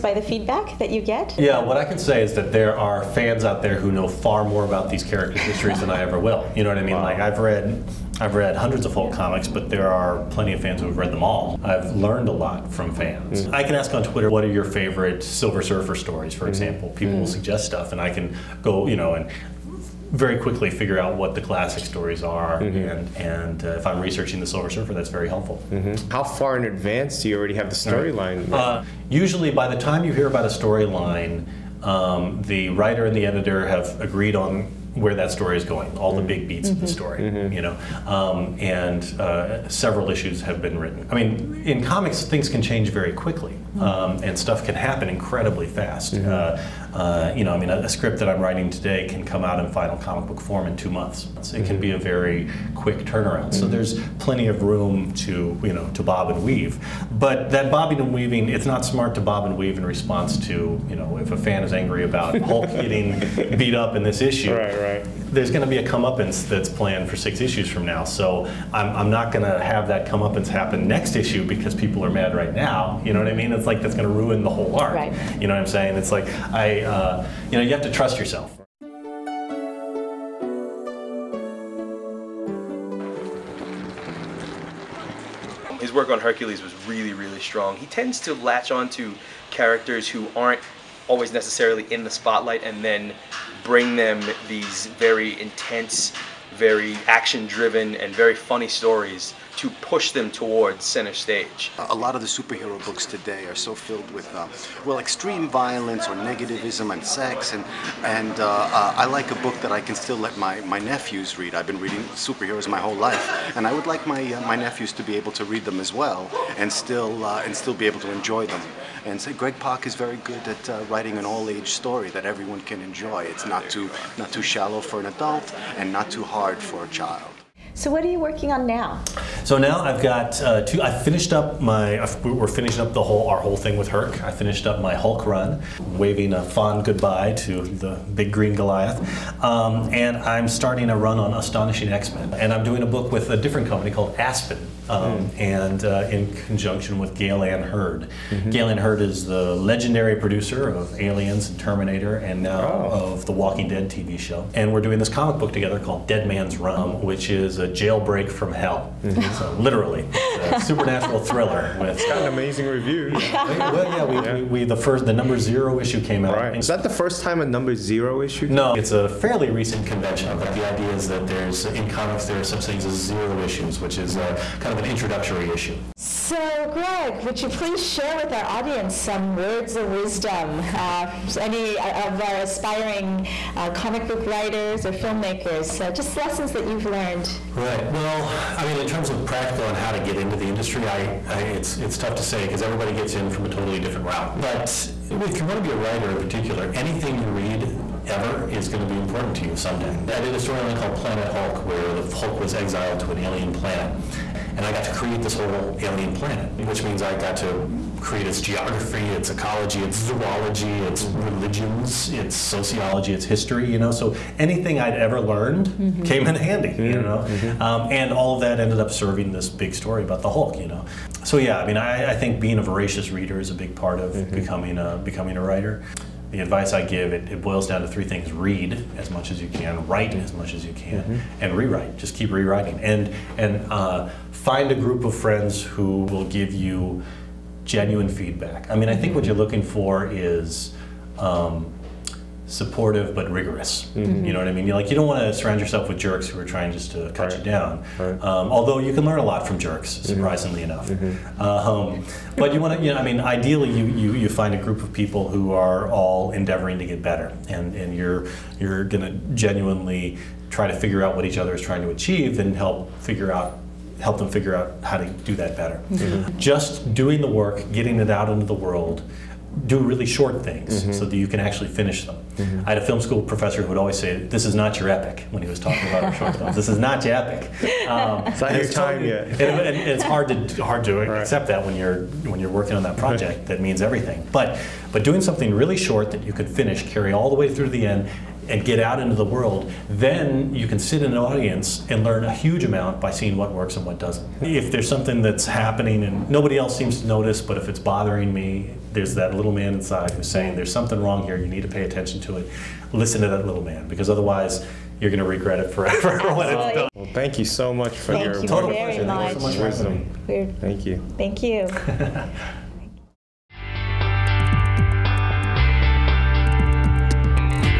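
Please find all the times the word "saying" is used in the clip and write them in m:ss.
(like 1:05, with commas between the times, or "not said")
1:15, 5:00.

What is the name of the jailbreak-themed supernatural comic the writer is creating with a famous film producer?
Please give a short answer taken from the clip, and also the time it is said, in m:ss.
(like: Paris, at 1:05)
Dead Man's Run, at 2:36.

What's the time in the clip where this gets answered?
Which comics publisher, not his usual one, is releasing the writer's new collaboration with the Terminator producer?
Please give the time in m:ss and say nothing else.
2:24.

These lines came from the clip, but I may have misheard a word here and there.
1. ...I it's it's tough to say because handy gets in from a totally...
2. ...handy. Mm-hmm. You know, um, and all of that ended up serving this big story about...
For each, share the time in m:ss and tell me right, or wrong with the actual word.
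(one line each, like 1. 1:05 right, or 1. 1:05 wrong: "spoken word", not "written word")
1. 3:11 wrong: "everybody", not "handy"
2. 3:36 right.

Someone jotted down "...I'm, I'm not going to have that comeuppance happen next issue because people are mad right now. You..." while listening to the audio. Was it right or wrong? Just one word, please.
right.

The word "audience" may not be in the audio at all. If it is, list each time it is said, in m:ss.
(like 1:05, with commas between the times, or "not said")
2:58, 4:51.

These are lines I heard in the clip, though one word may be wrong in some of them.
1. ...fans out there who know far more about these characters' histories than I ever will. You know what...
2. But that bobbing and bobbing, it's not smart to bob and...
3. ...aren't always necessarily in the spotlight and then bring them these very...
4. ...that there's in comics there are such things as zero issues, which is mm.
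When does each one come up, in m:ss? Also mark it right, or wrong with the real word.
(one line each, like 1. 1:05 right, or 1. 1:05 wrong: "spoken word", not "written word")
1. 0:03 right
2. 0:57 wrong: "weaving", not "bobbing"
3. 1:30 right
4. 2:51 right.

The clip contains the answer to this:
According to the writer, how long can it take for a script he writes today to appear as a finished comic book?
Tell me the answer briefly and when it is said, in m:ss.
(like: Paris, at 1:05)
2 months, at 0:50.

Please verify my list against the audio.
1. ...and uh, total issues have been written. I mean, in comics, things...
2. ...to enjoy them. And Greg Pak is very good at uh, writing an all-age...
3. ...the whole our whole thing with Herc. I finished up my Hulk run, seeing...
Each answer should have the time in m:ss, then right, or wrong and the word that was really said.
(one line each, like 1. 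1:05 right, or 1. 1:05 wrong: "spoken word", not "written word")
1. 0:38 wrong: "several", not "total"
2. 1:58 right
3. 2:12 wrong: "waving", not "seeing".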